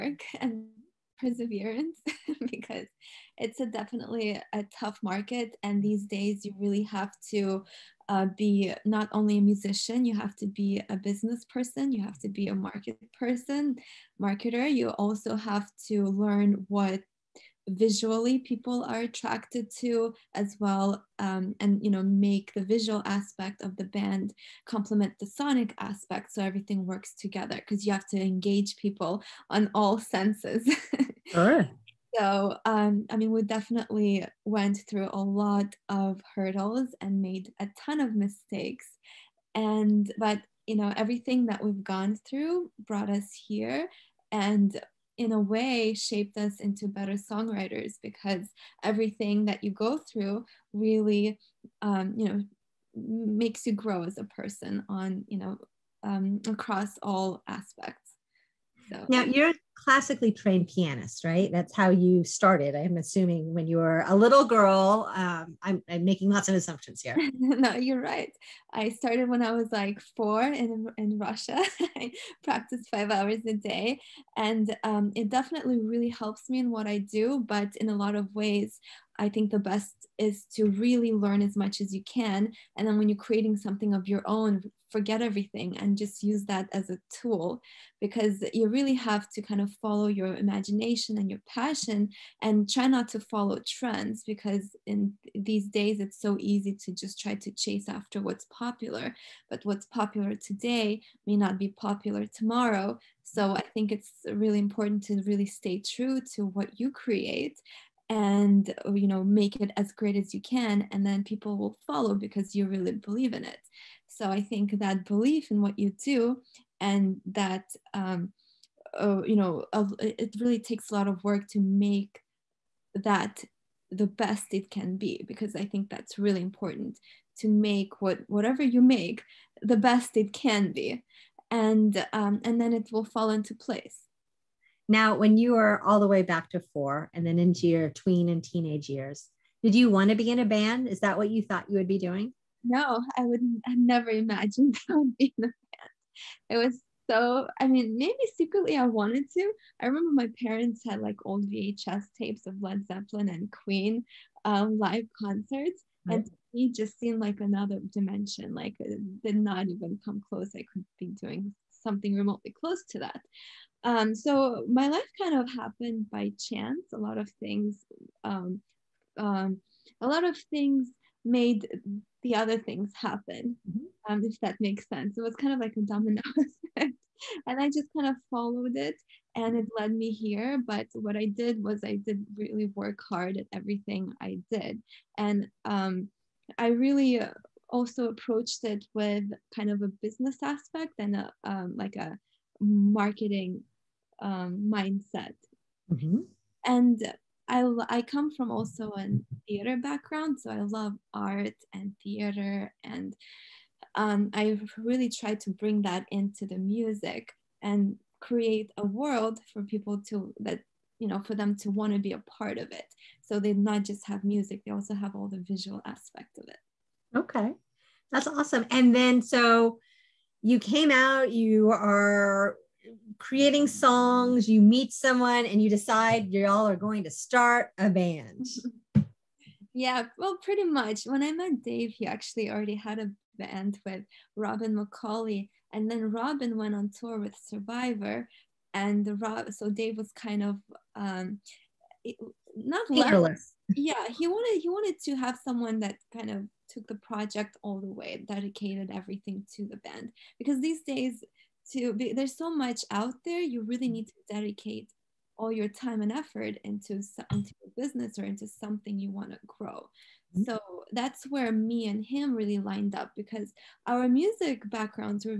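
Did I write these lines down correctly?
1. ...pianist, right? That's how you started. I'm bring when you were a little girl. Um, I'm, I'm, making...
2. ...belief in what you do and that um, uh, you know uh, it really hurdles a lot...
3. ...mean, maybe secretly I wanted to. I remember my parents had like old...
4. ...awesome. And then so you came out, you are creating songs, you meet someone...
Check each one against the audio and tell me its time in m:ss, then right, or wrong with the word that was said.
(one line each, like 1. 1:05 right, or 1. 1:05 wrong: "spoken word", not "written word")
1. 1:00 wrong: "assuming", not "bring"
2. 1:55 wrong: "takes", not "hurdles"
3. 2:27 right
4. 3:38 right.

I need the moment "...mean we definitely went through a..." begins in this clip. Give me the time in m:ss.
0:33.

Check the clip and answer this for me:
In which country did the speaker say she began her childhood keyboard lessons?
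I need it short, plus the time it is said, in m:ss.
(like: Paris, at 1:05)
Russia, at 1:11.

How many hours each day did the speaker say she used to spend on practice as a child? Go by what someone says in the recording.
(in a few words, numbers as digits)
5 hours.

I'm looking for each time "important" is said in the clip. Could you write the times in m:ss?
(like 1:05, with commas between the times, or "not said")
1:44, 2:06.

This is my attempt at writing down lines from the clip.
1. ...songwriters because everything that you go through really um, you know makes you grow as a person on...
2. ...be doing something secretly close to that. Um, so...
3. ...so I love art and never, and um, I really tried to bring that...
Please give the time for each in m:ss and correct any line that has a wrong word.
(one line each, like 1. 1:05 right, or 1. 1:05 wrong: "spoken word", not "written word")
1. 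0:47 right
2. 2:40 wrong: "remotely", not "secretly"
3. 3:20 wrong: "theater", not "never".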